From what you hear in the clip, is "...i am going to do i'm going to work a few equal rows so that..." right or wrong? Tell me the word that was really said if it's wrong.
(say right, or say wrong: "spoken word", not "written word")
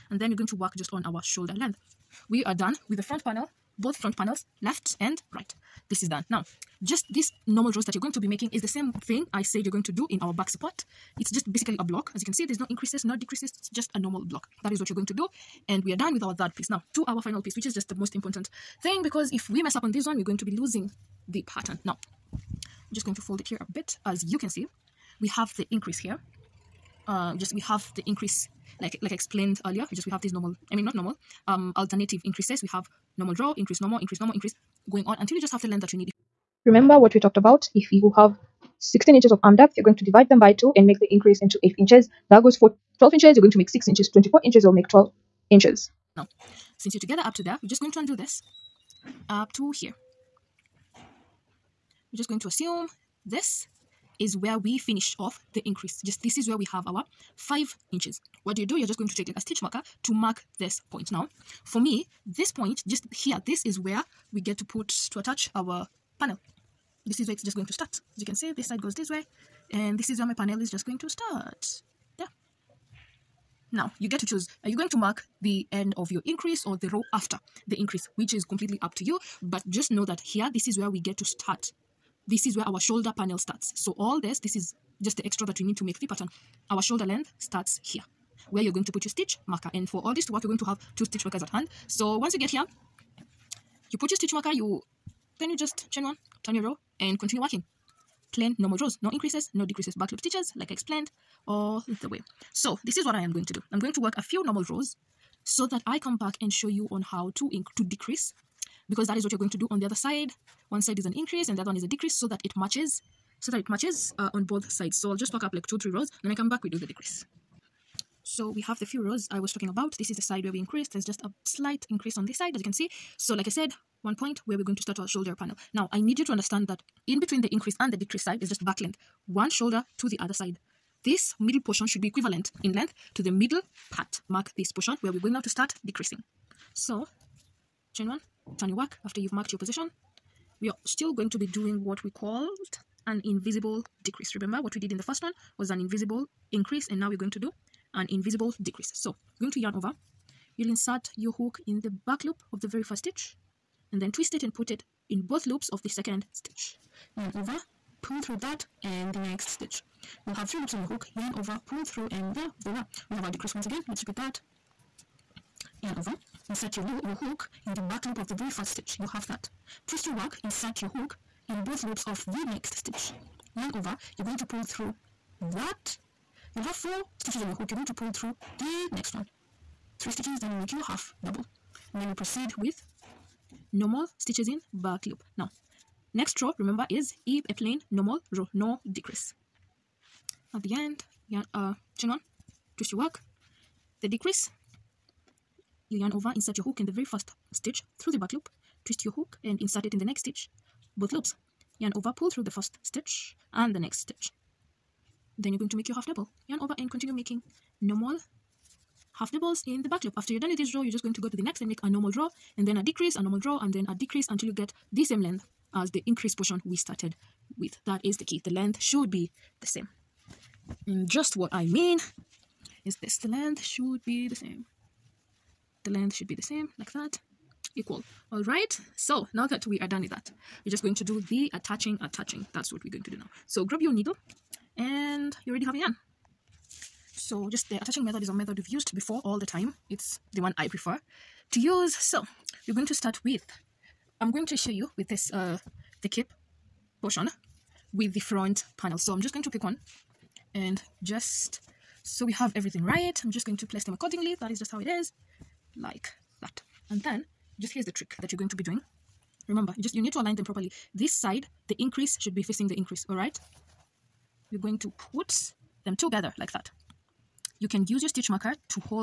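wrong: "normal", not "equal".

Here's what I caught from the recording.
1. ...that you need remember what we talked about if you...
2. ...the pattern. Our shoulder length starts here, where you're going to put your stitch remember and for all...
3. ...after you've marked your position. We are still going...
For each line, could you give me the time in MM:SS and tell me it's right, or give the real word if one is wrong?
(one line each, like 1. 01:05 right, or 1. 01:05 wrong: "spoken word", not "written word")
1. 00:35 right
2. 01:25 wrong: "marker", not "remember"
3. 02:19 right.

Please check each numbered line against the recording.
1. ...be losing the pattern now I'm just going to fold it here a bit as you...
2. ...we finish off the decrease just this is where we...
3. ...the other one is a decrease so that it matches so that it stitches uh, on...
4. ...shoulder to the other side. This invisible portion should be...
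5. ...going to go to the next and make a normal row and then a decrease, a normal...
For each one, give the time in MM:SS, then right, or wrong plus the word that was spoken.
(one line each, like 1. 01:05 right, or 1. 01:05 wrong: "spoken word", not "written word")
1. 00:20 right
2. 00:54 wrong: "increase", not "decrease"
3. 01:51 wrong: "matches", not "stitches"
4. 02:09 wrong: "middle", not "invisible"
5. 03:31 right.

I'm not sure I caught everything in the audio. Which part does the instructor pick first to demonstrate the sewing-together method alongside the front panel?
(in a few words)
the cape portion.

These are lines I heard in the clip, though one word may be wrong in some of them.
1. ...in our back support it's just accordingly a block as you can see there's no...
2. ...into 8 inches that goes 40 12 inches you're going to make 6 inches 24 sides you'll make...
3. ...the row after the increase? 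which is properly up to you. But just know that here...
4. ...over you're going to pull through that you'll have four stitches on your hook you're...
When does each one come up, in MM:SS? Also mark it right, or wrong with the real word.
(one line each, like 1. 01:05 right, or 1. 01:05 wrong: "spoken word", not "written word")
1. 00:10 wrong: "basically", not "accordingly"
2. 00:41 wrong: "inches", not "sides"
3. 01:16 wrong: "completely", not "properly"
4. 02:53 right.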